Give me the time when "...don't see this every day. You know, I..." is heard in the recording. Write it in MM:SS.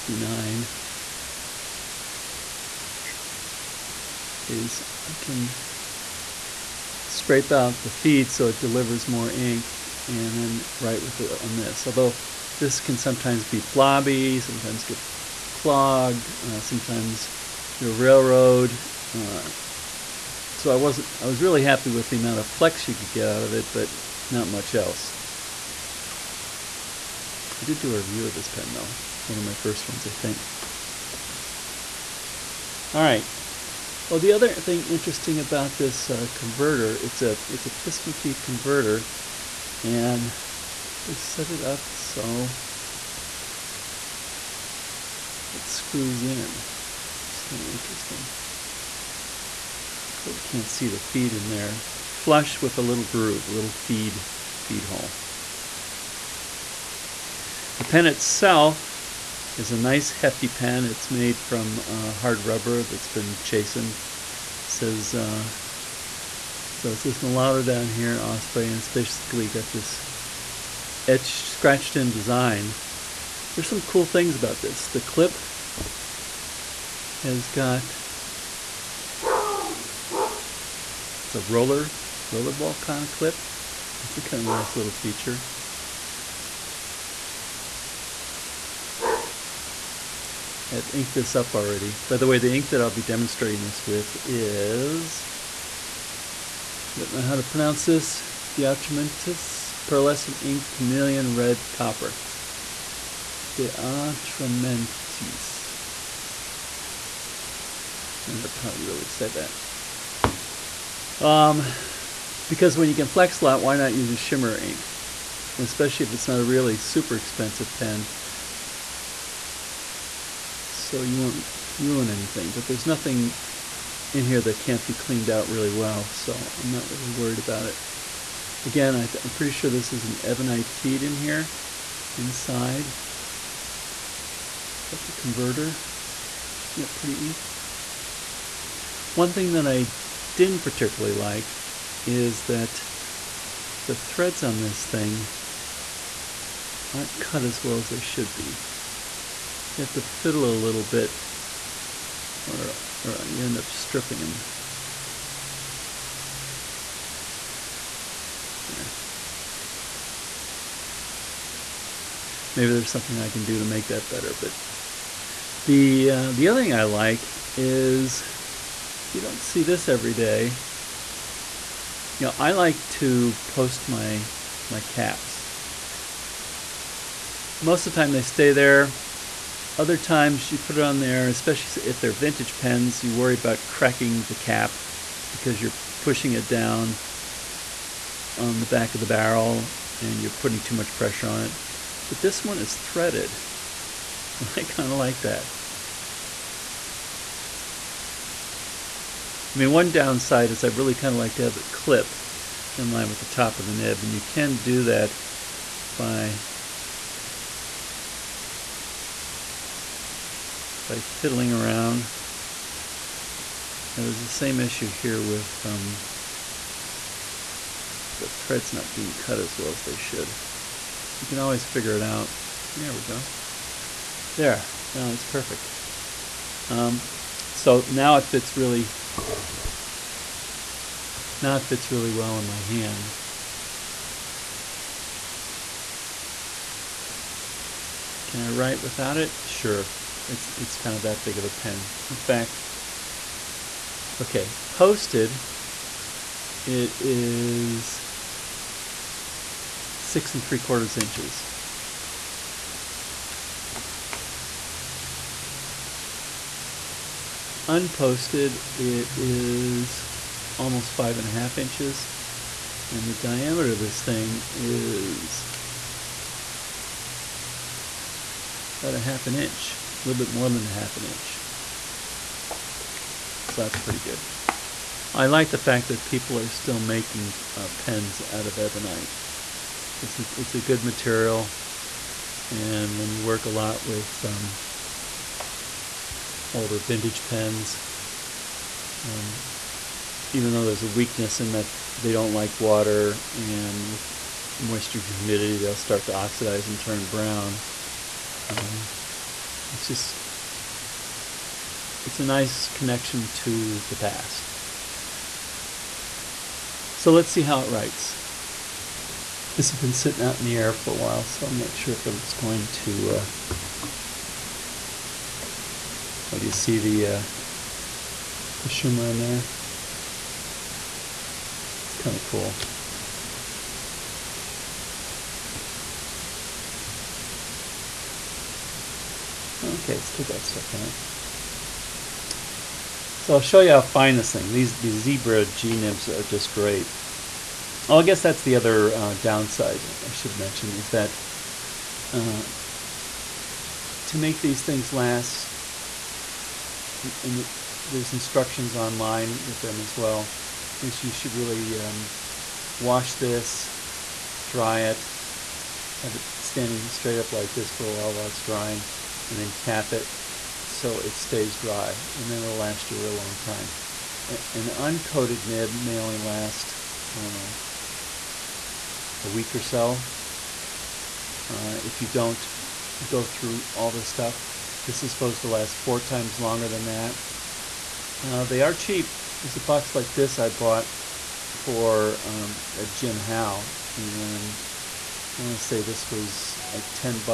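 02:49.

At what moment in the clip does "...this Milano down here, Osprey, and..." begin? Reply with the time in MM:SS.
01:07.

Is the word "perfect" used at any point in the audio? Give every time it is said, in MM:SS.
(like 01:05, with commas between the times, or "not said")
03:45.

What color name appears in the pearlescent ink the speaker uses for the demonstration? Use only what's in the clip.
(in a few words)
Chameleon Red Copper.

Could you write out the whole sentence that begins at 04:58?
Um, it's just, it's a nice connection to the past.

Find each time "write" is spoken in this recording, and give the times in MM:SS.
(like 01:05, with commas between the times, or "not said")
00:10, 03:58, 05:07.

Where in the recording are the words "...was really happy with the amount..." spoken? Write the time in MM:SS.
00:21.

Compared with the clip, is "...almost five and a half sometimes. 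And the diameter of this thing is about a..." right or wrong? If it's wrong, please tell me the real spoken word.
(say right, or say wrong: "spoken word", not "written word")
wrong: "inches", not "sometimes".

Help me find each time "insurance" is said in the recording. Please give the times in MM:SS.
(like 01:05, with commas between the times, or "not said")
not said.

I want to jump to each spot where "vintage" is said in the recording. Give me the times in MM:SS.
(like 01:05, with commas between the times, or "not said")
03:02, 04:46.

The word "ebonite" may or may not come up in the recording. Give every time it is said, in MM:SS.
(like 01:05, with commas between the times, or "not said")
02:10, 04:38.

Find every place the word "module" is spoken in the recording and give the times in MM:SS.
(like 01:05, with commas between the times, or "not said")
not said.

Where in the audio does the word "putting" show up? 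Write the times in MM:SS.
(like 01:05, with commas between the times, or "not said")
03:10.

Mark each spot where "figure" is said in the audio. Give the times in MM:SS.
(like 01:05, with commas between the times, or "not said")
03:41.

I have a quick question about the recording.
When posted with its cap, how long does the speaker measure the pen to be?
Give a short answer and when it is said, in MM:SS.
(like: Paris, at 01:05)
6 3/4 inches, at 04:09.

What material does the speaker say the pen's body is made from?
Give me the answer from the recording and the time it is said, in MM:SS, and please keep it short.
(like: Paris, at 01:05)
Hard rubber, at 01:02.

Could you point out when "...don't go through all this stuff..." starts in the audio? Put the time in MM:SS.
06:12.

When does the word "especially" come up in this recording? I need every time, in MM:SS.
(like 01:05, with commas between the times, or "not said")
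01:55, 03:01.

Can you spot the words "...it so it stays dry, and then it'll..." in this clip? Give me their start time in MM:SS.
05:59.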